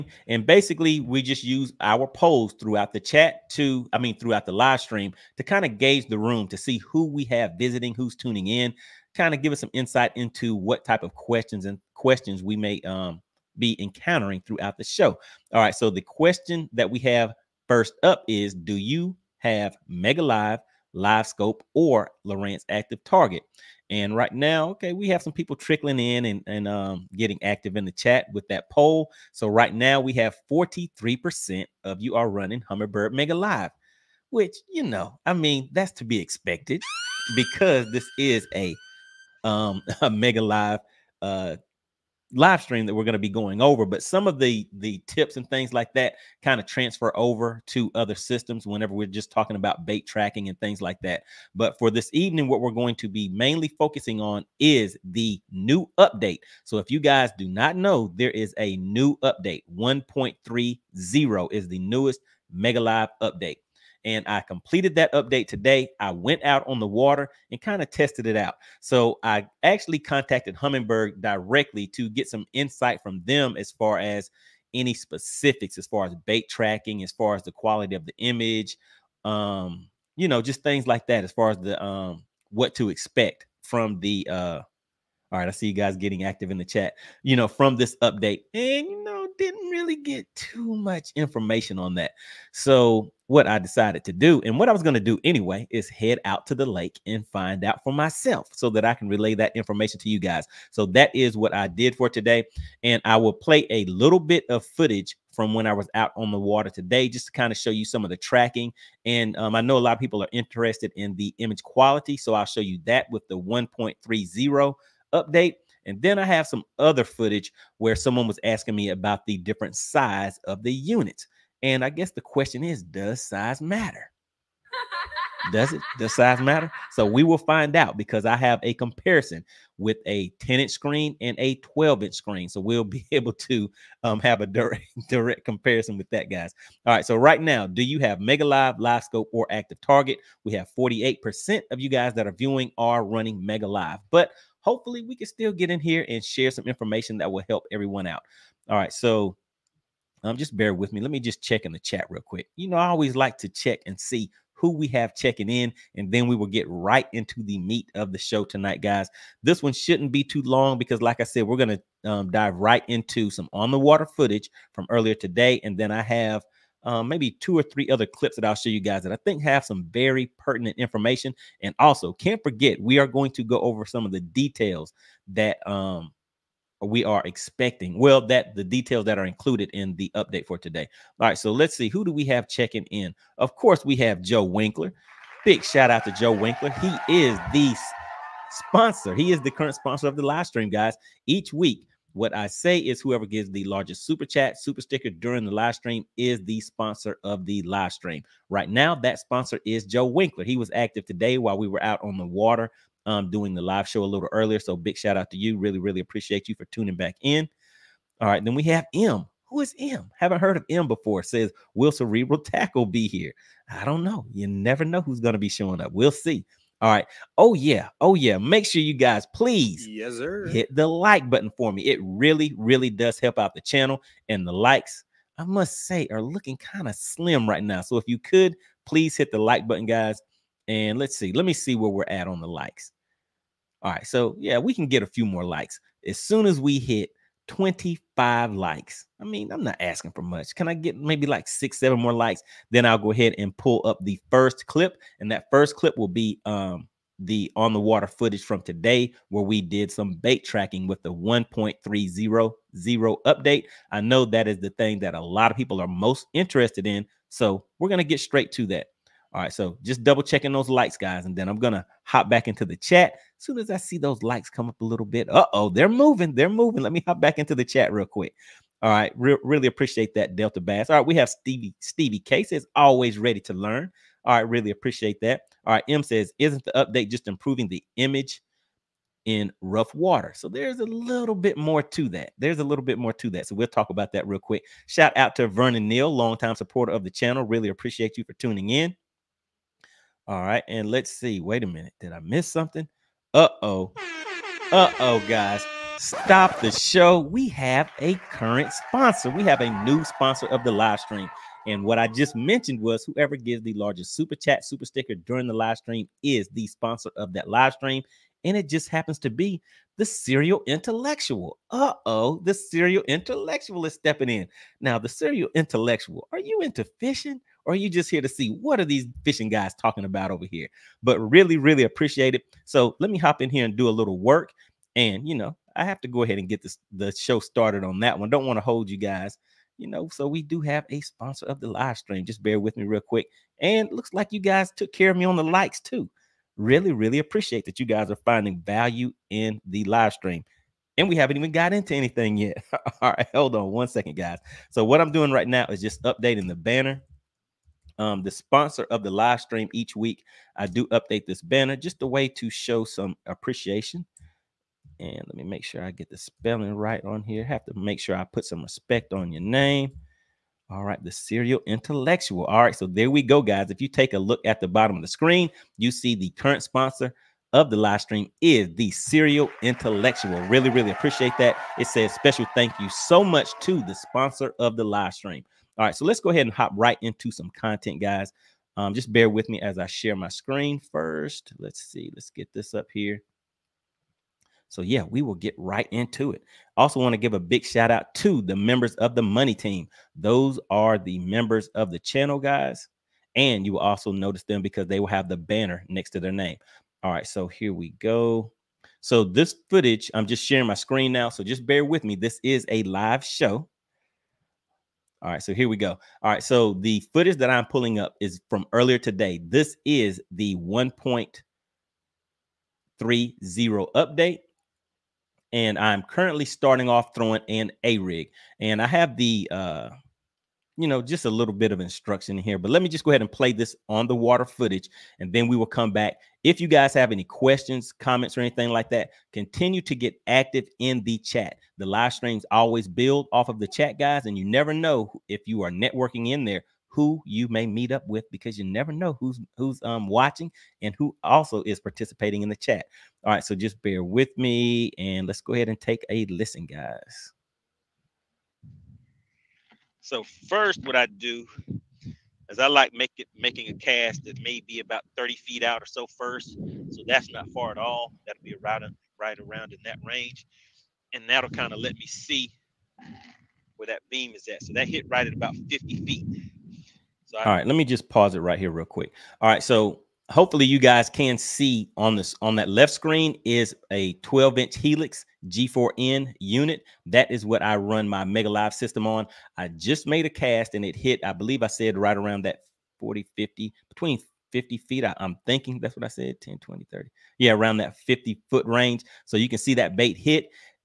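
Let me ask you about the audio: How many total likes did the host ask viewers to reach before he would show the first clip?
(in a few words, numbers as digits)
25.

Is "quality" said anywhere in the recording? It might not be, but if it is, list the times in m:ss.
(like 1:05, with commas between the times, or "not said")
1:17, 1:51.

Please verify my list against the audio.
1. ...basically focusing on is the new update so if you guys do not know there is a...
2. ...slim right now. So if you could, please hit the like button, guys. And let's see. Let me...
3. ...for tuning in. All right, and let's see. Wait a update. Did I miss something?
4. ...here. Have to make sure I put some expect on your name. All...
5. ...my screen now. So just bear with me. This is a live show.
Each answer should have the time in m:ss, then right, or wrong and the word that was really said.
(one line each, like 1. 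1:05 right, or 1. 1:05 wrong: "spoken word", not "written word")
1. 0:53 wrong: "mainly", not "basically"
2. 3:46 right
3. 4:48 wrong: "minute", not "update"
4. 5:57 wrong: "respect", not "expect"
5. 6:40 right.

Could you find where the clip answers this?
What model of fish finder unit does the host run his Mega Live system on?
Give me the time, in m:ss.
7:54.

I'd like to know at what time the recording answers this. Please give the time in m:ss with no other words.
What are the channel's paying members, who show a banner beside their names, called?
6:29.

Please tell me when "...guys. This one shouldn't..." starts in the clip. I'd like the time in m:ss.
2:38.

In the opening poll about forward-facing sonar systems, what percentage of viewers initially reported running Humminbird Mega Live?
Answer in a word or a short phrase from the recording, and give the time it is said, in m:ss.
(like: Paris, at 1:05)
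43%, at 0:30.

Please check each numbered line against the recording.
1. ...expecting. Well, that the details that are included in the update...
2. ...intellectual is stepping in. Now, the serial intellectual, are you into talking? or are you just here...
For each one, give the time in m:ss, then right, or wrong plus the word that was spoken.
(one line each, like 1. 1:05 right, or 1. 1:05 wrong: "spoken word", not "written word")
1. 2:57 right
2. 5:13 wrong: "fishing", not "talking".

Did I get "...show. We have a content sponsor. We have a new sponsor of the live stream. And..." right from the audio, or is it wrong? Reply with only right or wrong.
wrong.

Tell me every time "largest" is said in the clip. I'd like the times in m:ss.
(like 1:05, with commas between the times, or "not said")
3:13, 5:03.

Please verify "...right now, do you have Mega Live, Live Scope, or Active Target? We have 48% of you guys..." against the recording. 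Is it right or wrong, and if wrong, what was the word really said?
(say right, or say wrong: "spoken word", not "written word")
right.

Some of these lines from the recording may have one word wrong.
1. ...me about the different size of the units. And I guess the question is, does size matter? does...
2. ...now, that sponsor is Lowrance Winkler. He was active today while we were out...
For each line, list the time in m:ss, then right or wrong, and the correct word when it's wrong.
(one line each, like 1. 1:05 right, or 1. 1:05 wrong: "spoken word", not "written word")
1. 1:58 right
2. 3:18 wrong: "Joe", not "Lowrance".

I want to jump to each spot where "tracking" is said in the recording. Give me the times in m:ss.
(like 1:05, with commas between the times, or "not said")
0:50, 1:16, 1:48, 4:10.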